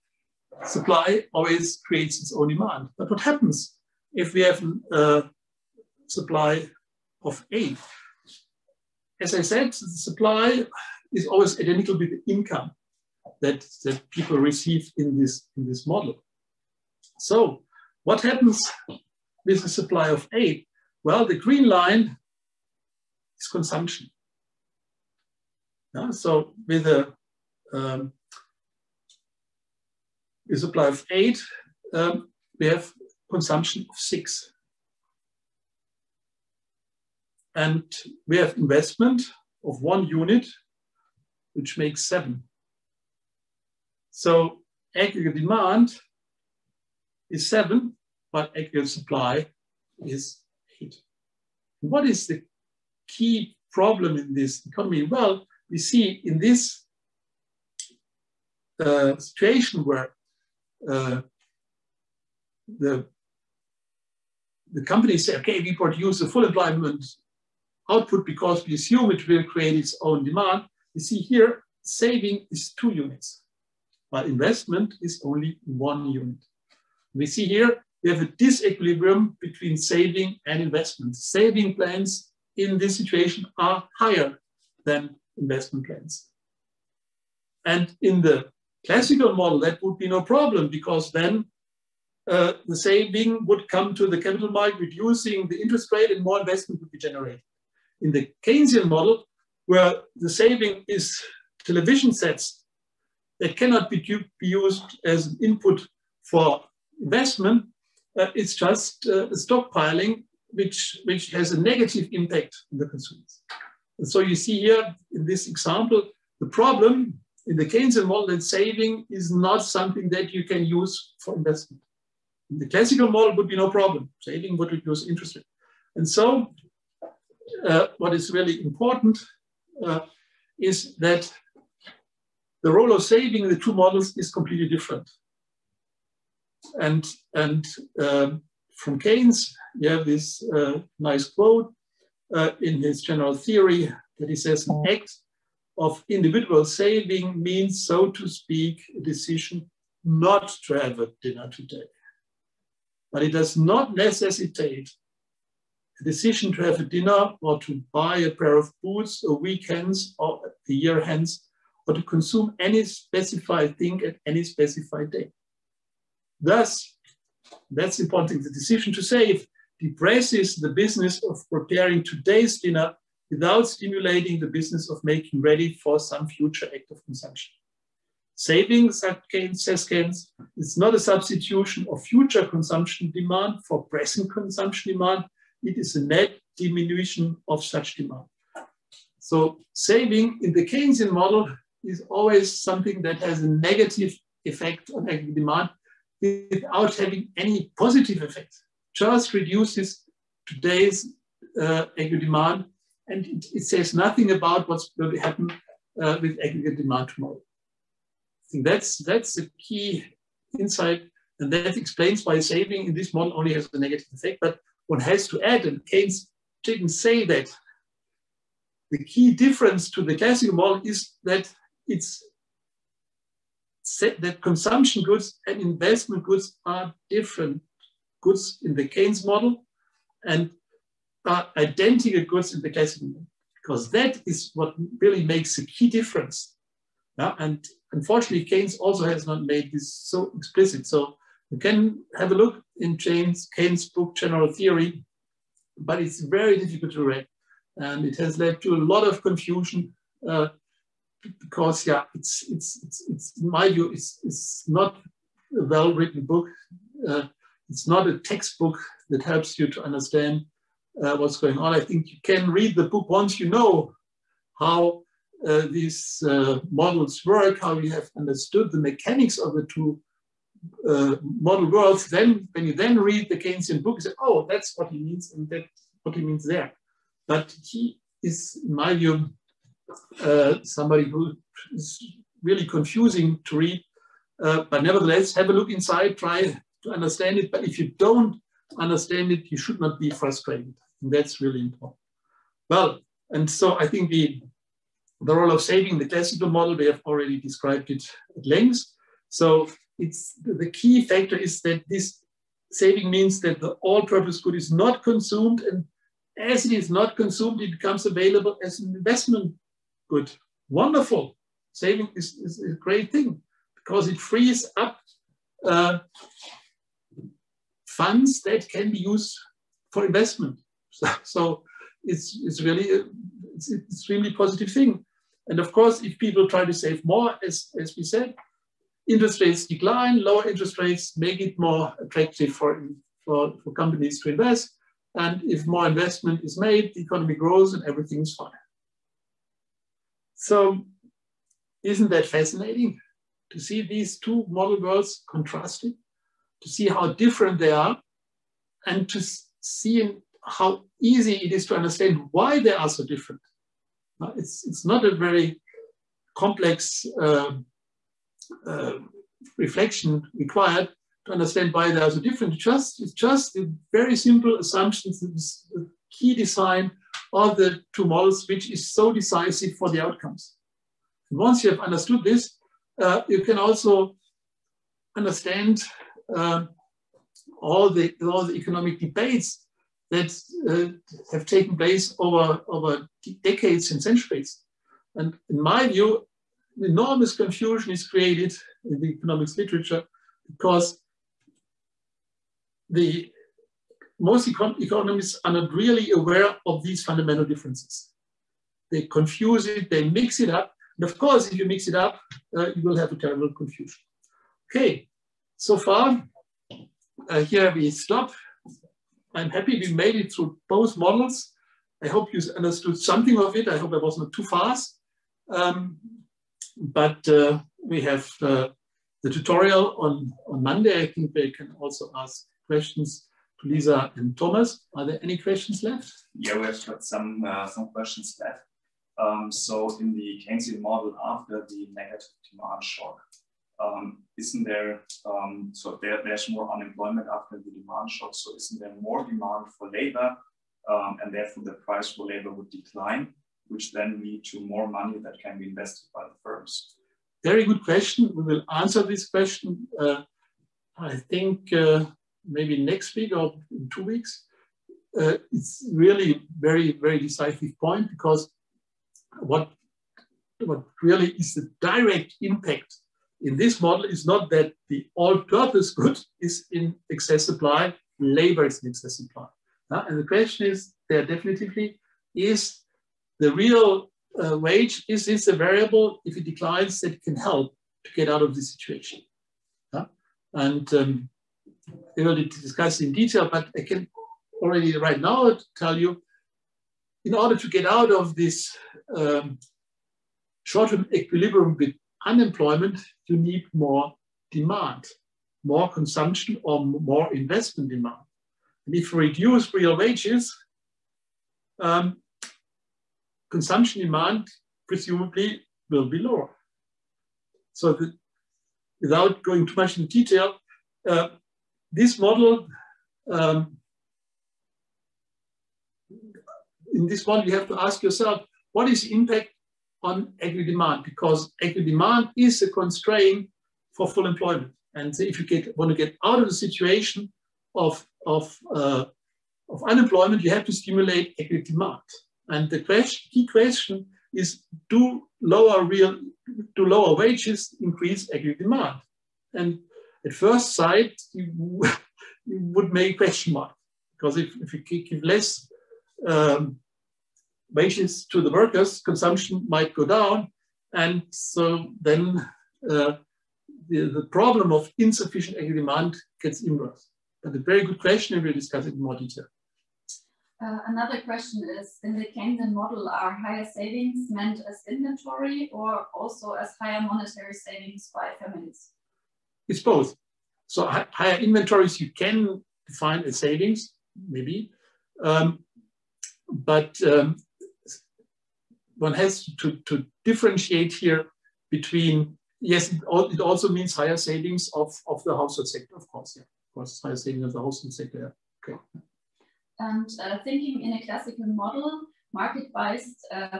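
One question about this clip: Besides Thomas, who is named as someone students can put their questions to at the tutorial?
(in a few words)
Lisa.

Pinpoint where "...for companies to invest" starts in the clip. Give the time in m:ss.
5:33.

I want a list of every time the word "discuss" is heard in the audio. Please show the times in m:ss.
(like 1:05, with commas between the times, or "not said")
8:02, 9:18.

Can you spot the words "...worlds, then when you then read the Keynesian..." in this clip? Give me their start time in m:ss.
4:31.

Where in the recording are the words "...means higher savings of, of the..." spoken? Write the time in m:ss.
9:43.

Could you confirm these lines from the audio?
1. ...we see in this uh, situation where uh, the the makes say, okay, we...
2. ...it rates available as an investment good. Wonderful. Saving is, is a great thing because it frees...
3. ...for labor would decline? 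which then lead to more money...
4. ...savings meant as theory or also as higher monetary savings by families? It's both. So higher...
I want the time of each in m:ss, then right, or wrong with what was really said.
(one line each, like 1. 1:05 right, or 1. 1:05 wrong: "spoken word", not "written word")
1. 0:55 wrong: "companies", not "makes"
2. 5:07 wrong: "becomes", not "rates"
3. 7:22 right
4. 9:23 wrong: "inventory", not "theory".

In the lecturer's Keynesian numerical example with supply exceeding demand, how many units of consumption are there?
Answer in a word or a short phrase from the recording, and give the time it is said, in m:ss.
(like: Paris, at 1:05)
6, at 0:32.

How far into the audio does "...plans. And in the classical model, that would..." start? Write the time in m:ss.
1:25.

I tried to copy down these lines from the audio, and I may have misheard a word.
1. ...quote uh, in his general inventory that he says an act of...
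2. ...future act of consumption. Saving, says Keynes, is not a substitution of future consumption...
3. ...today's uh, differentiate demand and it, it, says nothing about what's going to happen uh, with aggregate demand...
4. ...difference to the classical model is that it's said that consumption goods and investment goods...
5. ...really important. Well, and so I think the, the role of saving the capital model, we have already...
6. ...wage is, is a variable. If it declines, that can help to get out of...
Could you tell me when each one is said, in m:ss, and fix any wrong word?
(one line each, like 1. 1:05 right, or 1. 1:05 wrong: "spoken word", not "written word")
1. 2:21 wrong: "theory", not "inventory"
2. 2:56 right
3. 3:20 wrong: "aggregate", not "differentiate"
4. 3:39 right
5. 4:51 wrong: "classical", not "capital"
6. 7:54 right.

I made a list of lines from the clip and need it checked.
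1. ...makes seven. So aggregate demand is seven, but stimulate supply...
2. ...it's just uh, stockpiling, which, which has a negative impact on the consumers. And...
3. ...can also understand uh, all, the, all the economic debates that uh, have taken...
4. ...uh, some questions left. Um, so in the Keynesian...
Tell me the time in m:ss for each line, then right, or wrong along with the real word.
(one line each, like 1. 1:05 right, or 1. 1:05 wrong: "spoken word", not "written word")
1. 0:41 wrong: "aggregate", not "stimulate"
2. 1:48 right
3. 6:13 right
4. 7:07 right.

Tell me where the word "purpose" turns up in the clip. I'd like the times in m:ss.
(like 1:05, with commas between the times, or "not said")
5:03, 7:45.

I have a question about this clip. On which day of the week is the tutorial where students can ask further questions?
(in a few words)
Monday.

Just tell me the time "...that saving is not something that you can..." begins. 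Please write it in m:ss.
1:58.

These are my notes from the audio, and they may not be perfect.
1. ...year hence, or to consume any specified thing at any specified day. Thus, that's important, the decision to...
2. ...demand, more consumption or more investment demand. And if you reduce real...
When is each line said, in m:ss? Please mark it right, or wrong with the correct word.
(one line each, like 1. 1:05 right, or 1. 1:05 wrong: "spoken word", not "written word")
1. 2:40 right
2. 8:14 right.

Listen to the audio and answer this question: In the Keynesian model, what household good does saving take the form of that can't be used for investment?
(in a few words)
television sets.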